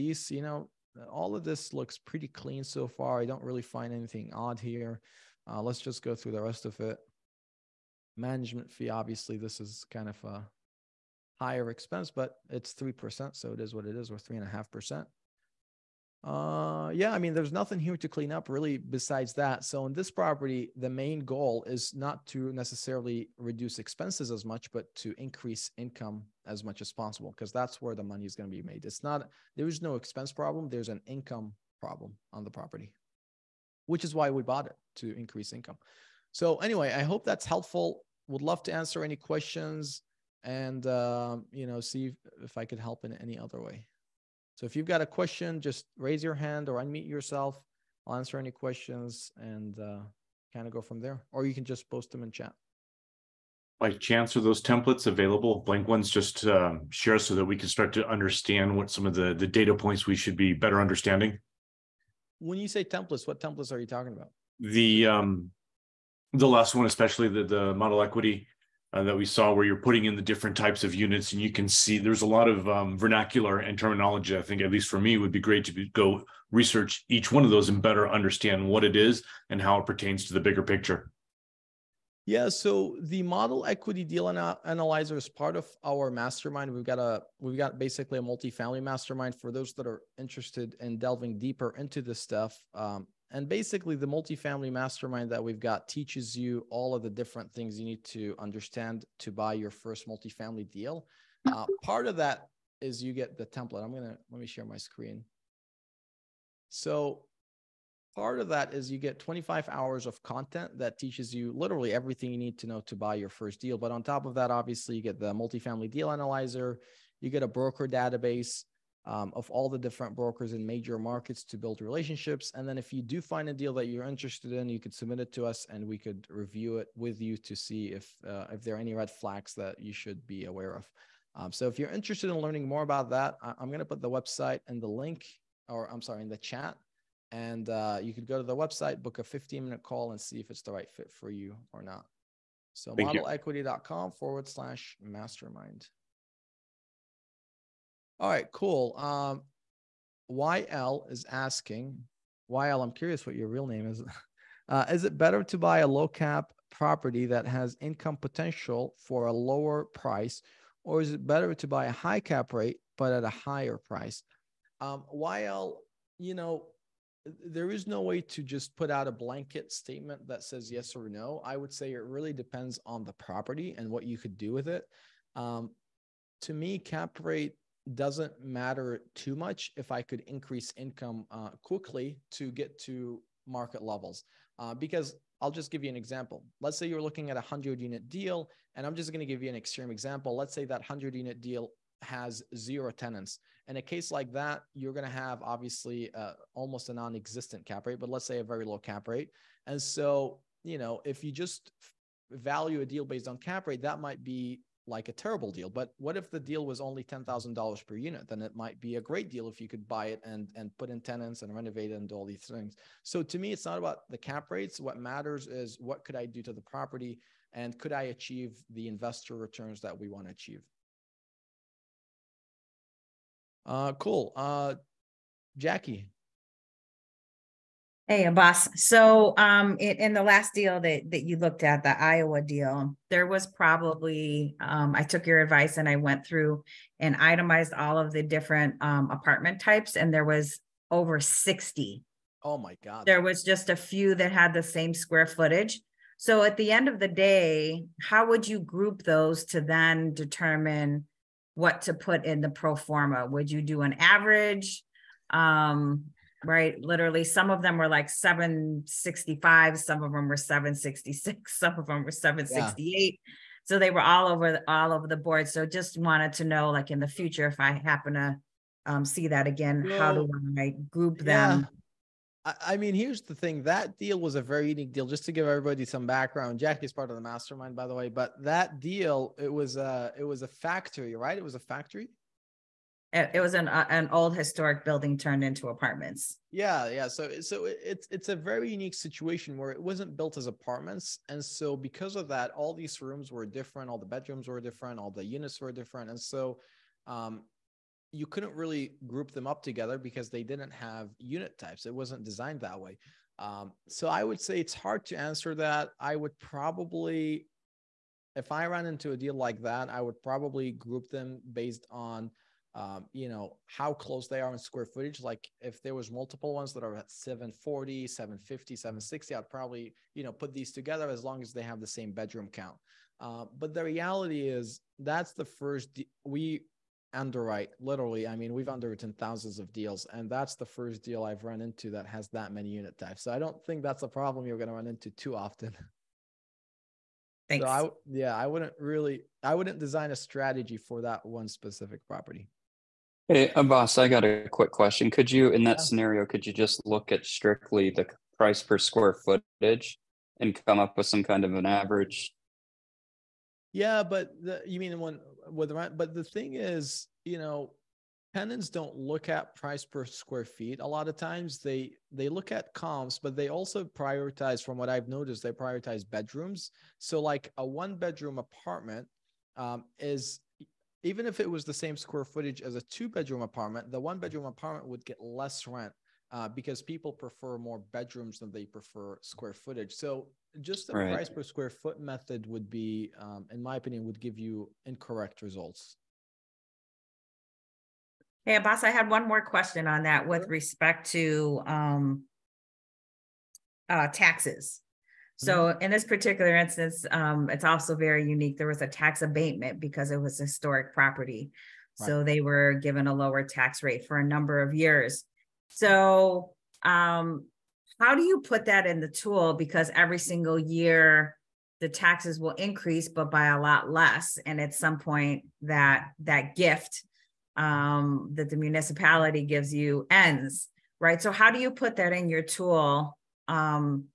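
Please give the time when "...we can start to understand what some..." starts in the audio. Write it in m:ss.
0:57.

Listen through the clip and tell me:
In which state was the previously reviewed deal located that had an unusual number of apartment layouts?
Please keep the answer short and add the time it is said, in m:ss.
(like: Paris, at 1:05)
Iowa, at 3:51.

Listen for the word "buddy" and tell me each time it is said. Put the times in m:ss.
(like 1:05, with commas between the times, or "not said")
not said.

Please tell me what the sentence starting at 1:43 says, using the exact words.
I'm going to let me share my screen.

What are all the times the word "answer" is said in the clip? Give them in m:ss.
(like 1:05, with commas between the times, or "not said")
0:38, 0:48, 5:05.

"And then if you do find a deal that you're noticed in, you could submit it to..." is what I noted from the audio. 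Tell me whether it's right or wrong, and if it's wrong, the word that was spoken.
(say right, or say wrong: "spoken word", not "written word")
wrong: "interested", not "noticed".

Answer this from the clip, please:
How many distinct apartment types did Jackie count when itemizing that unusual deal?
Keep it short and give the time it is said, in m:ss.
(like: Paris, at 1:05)
over 60, at 4:00.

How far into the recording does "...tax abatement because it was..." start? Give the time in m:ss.
6:38.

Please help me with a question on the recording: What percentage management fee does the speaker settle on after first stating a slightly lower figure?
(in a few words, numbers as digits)
3.5%.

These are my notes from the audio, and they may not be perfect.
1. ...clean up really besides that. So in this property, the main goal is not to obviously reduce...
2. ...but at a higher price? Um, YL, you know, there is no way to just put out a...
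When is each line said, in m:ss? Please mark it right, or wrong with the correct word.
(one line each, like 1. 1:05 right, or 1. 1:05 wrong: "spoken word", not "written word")
1. 0:18 wrong: "necessarily", not "obviously"
2. 2:42 right.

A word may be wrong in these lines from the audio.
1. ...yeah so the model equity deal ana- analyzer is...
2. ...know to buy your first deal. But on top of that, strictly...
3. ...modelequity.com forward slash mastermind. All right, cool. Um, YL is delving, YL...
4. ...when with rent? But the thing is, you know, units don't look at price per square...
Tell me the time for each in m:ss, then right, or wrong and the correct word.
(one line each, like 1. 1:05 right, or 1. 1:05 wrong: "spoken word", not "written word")
1. 1:22 right
2. 1:52 wrong: "obviously", not "strictly"
3. 2:23 wrong: "asking", not "delving"
4. 5:54 wrong: "tenants", not "units".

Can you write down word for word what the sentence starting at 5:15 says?
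Like if there was multiple ones that are at 740, 750, mm-hmm.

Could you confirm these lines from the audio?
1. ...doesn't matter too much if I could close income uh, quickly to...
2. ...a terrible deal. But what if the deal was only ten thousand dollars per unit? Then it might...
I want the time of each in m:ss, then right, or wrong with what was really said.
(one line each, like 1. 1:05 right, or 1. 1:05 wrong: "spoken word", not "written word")
1. 2:57 wrong: "increase", not "close"
2. 3:25 right.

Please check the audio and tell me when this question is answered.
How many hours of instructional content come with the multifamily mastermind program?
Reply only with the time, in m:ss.
1:49.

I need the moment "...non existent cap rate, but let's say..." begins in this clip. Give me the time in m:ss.
3:16.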